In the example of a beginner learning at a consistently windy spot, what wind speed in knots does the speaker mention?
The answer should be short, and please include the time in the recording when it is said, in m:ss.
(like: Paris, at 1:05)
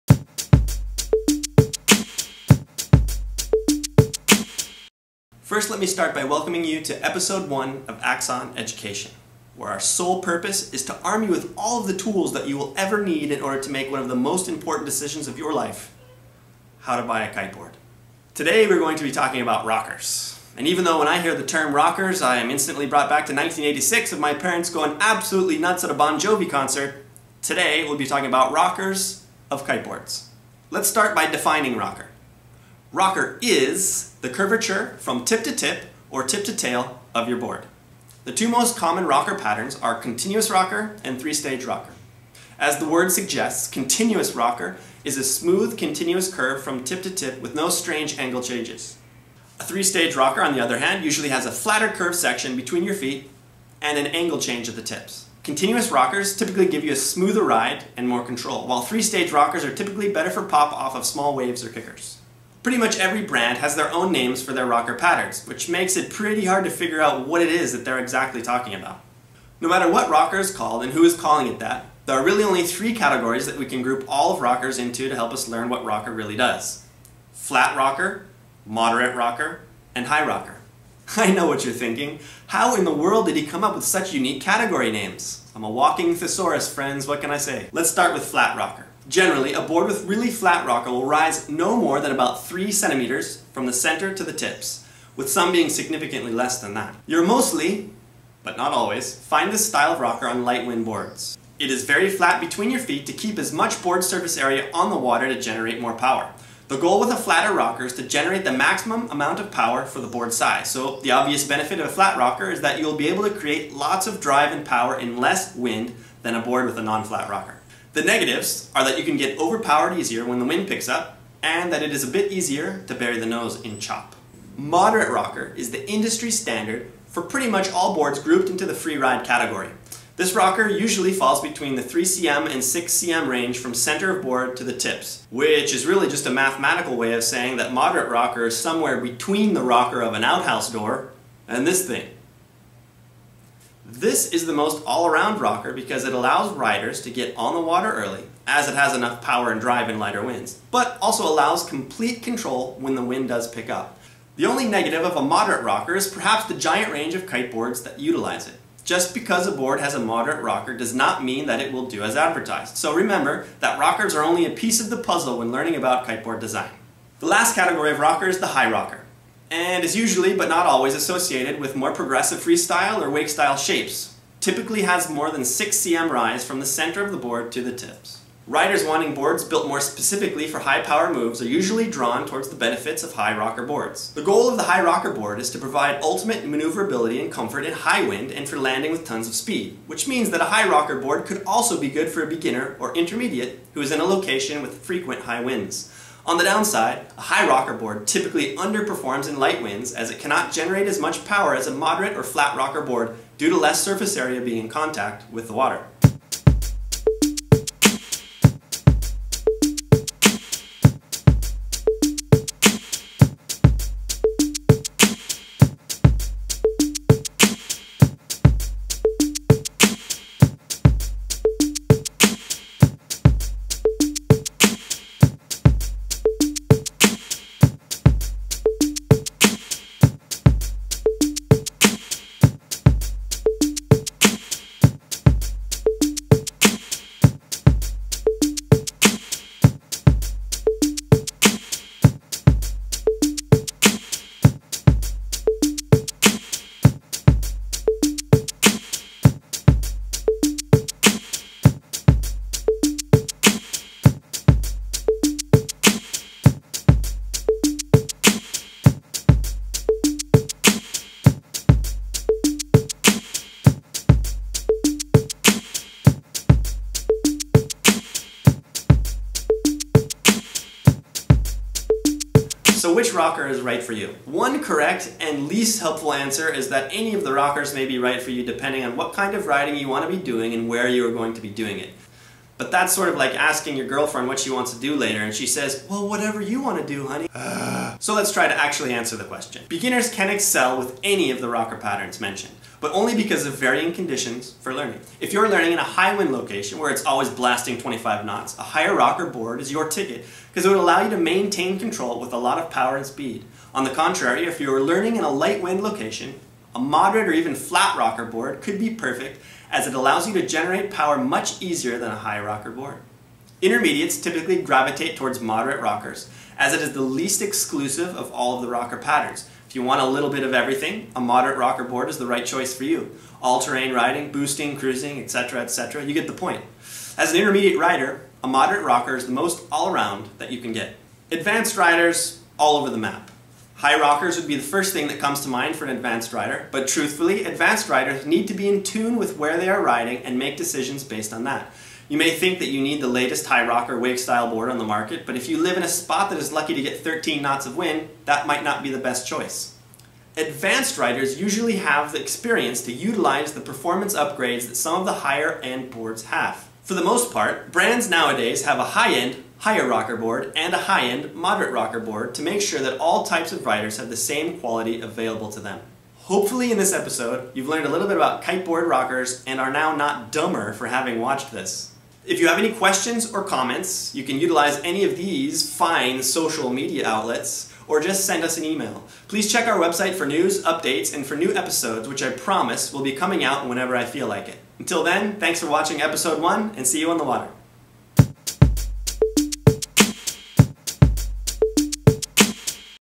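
25 knots, at 4:57.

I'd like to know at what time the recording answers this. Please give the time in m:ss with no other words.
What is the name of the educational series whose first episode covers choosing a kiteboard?
0:08.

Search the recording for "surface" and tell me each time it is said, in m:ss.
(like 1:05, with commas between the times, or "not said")
1:44, 3:23.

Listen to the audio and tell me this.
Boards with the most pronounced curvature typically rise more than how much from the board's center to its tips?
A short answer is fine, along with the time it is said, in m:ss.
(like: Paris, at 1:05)
6 cm, at 2:55.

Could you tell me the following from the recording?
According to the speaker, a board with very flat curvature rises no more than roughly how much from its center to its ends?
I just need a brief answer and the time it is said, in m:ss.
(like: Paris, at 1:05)
3 cm, at 1:32.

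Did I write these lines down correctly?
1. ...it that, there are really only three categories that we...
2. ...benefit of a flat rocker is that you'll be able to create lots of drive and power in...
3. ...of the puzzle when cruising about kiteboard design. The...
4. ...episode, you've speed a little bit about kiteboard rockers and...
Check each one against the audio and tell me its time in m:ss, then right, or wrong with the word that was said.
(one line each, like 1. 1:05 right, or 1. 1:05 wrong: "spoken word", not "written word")
1. 1:11 right
2. 1:51 right
3. 2:44 wrong: "learning", not "cruising"
4. 6:06 wrong: "learned", not "speed".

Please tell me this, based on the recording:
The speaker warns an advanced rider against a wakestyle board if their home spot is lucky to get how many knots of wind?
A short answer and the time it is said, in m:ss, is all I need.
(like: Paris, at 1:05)
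13 knots, at 5:46.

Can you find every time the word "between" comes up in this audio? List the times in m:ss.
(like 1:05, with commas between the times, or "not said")
0:52, 1:42, 2:11, 2:19.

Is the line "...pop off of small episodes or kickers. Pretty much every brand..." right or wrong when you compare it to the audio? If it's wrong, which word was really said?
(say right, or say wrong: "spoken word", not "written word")
wrong: "waves", not "episodes".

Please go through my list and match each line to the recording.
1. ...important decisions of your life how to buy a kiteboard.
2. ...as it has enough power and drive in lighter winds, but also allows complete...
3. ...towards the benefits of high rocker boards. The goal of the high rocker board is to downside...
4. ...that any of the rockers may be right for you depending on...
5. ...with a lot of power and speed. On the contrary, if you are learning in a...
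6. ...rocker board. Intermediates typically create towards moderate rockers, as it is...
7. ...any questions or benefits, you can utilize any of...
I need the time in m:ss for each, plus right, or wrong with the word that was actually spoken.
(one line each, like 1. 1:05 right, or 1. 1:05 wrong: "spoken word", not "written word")
1. 0:14 right
2. 2:28 right
3. 3:02 wrong: "provide", not "downside"
4. 4:36 right
5. 5:02 right
6. 5:12 wrong: "gravitate", not "create"
7. 6:12 wrong: "comments", not "benefits".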